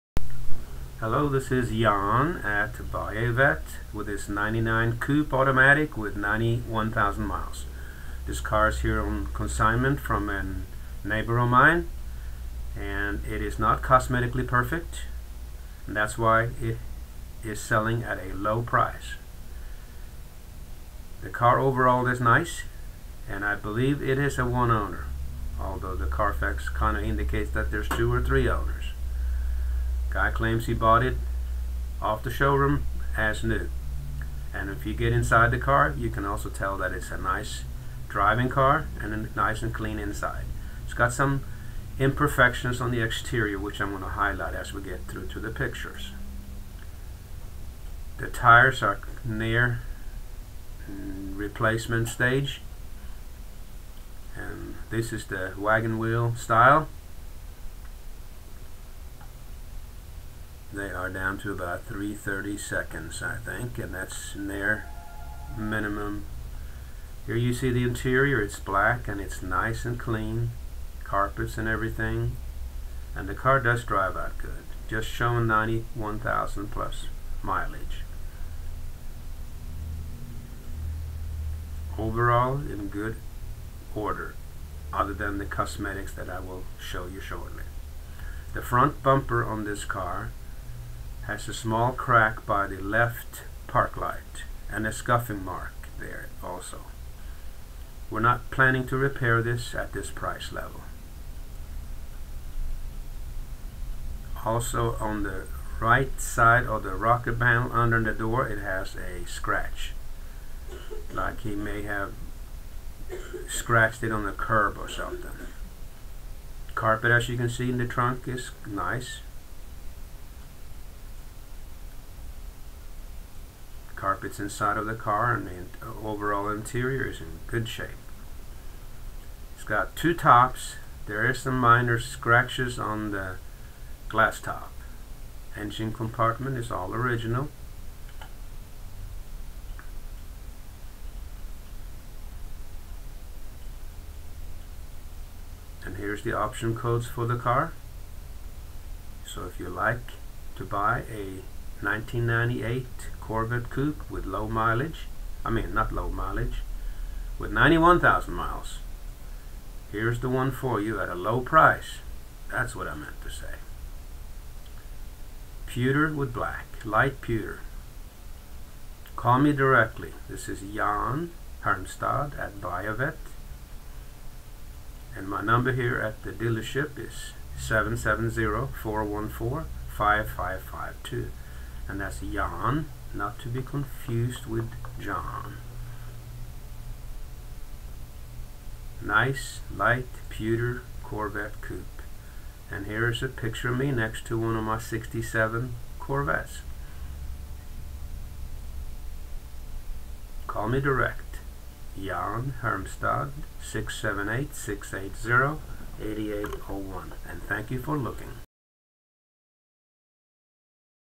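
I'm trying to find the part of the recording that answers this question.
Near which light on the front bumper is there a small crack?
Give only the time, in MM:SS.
01:32.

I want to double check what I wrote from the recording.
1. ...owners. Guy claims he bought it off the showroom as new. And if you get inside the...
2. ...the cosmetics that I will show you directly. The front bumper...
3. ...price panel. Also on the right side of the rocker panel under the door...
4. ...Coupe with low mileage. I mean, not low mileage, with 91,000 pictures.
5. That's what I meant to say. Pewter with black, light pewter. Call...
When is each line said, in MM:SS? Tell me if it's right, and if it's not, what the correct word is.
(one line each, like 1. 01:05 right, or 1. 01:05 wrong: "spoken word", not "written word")
1. 00:28 right
2. 01:25 wrong: "shortly", not "directly"
3. 01:40 wrong: "level", not "panel"
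4. 02:33 wrong: "miles", not "pictures"
5. 02:42 right.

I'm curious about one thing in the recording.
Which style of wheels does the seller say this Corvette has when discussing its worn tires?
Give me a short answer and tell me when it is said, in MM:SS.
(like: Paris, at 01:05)
wagon wheel, at 00:55.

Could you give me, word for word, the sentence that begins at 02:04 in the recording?
carpets inside of the car and the overall interior is in good shape.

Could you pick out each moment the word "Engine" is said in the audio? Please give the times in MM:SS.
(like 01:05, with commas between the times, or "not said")
02:15.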